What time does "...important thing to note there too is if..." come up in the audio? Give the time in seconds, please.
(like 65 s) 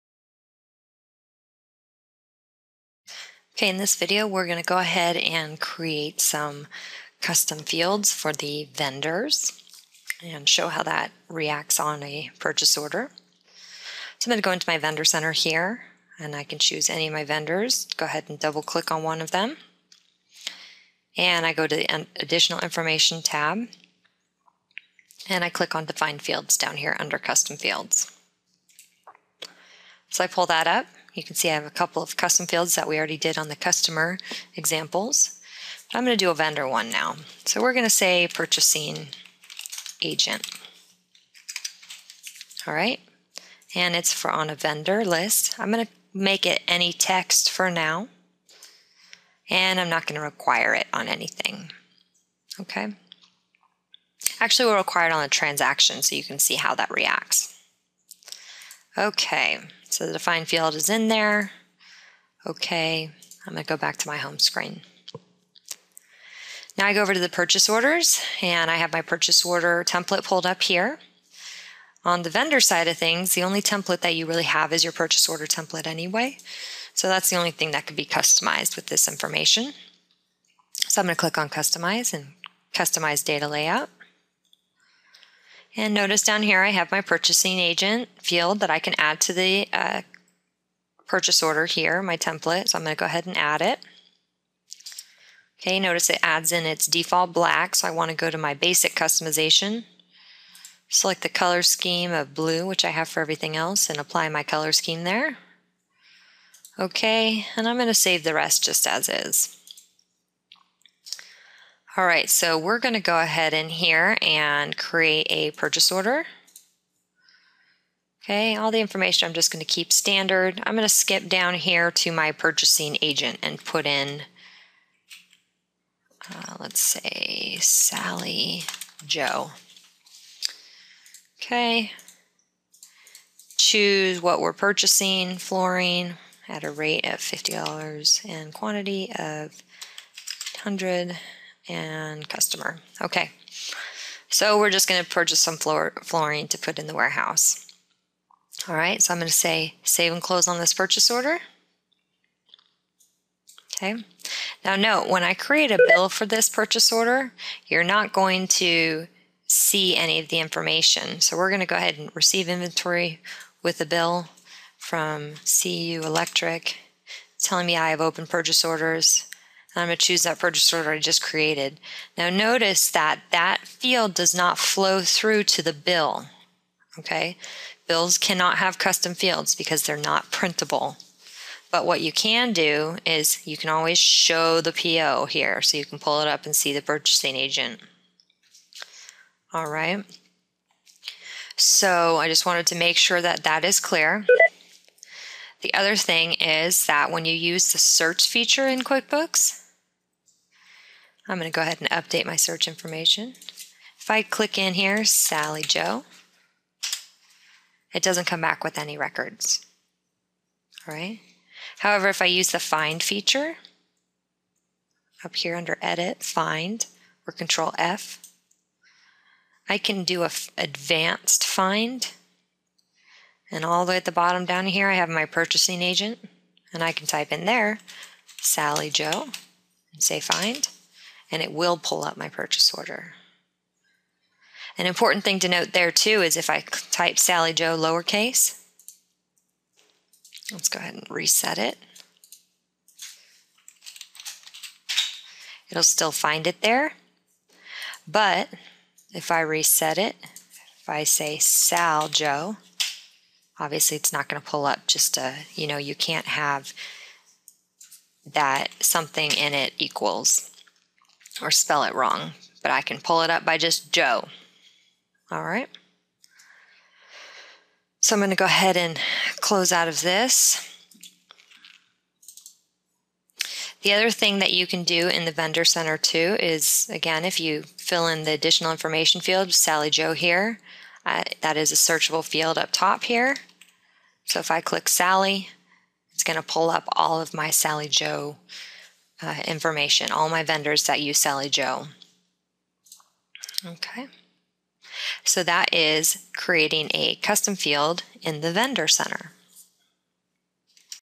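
234 s.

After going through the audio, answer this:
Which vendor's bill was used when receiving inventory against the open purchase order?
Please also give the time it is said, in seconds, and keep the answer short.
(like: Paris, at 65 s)
CU Electric, at 165 s.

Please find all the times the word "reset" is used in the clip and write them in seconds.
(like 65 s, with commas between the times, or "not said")
241 s, 249 s.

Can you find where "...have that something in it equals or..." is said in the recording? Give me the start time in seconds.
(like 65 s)
256 s.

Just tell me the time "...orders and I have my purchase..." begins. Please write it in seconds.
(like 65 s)
67 s.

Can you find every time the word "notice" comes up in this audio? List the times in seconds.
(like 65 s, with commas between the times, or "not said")
85 s, 95 s, 172 s.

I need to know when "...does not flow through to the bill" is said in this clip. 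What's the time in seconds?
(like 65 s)
174 s.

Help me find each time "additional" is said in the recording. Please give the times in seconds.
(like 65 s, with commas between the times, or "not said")
22 s, 278 s.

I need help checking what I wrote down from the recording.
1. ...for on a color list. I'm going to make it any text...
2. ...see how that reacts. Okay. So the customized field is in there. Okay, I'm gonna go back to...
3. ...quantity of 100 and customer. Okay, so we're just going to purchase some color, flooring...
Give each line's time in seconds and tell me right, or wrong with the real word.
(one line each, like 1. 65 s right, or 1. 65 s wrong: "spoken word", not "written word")
1. 44 s wrong: "vendor", not "color"
2. 56 s wrong: "defined", not "customized"
3. 138 s wrong: "floor", not "color".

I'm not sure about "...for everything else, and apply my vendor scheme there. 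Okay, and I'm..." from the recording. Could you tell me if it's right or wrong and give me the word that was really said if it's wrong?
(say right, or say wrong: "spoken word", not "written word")
wrong: "color", not "vendor".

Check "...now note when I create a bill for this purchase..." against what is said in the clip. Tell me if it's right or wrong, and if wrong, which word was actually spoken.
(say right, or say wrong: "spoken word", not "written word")
right.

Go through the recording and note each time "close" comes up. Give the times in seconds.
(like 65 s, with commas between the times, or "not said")
150 s, 269 s.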